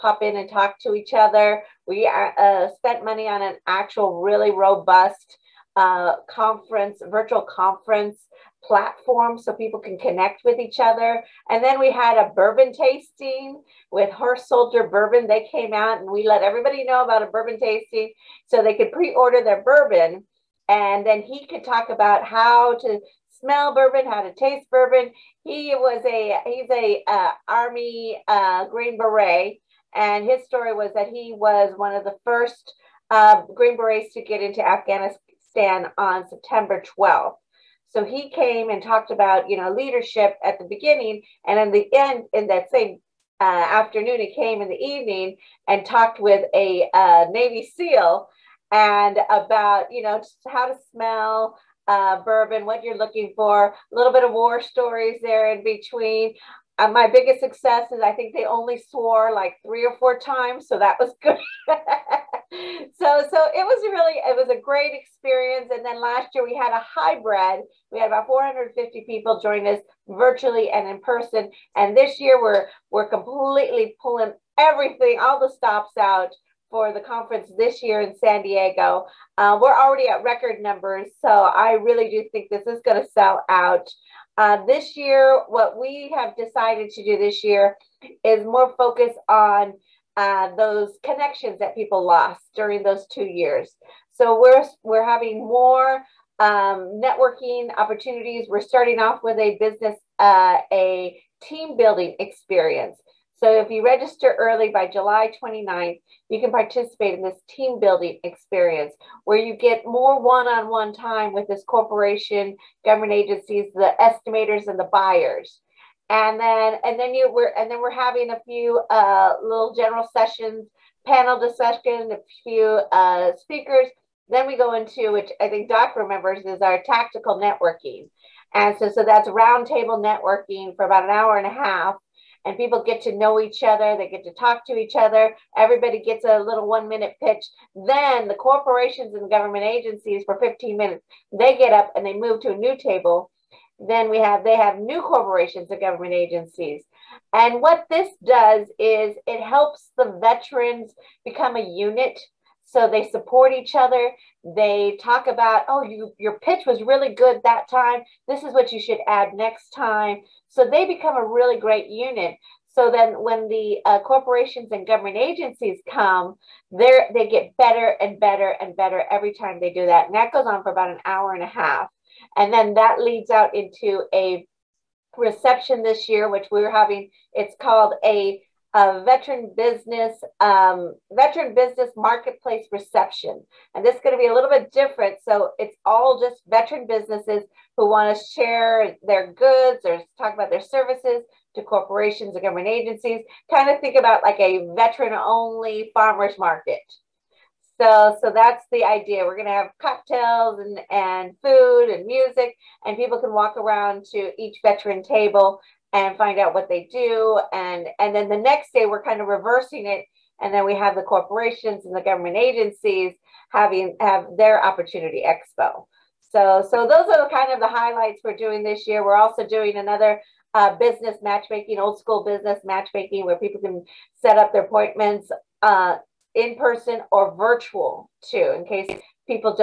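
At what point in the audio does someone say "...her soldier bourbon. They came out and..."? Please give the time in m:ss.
0:14.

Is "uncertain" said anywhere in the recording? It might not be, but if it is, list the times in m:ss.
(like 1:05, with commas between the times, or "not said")
not said.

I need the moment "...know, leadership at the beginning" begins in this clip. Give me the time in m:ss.
0:39.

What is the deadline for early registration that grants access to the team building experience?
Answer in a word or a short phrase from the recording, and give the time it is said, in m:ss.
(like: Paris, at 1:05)
July 29th, at 1:44.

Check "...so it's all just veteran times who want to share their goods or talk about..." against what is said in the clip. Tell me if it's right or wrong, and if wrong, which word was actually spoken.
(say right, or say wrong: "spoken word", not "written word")
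wrong: "businesses", not "times".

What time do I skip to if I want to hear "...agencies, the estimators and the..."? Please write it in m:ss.
1:53.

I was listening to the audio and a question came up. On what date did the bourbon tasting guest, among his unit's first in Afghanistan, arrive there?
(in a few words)
September 12th.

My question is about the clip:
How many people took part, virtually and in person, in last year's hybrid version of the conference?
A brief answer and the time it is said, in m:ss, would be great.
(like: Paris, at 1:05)
450, at 1:08.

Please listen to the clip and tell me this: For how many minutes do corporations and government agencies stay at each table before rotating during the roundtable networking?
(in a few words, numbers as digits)
15.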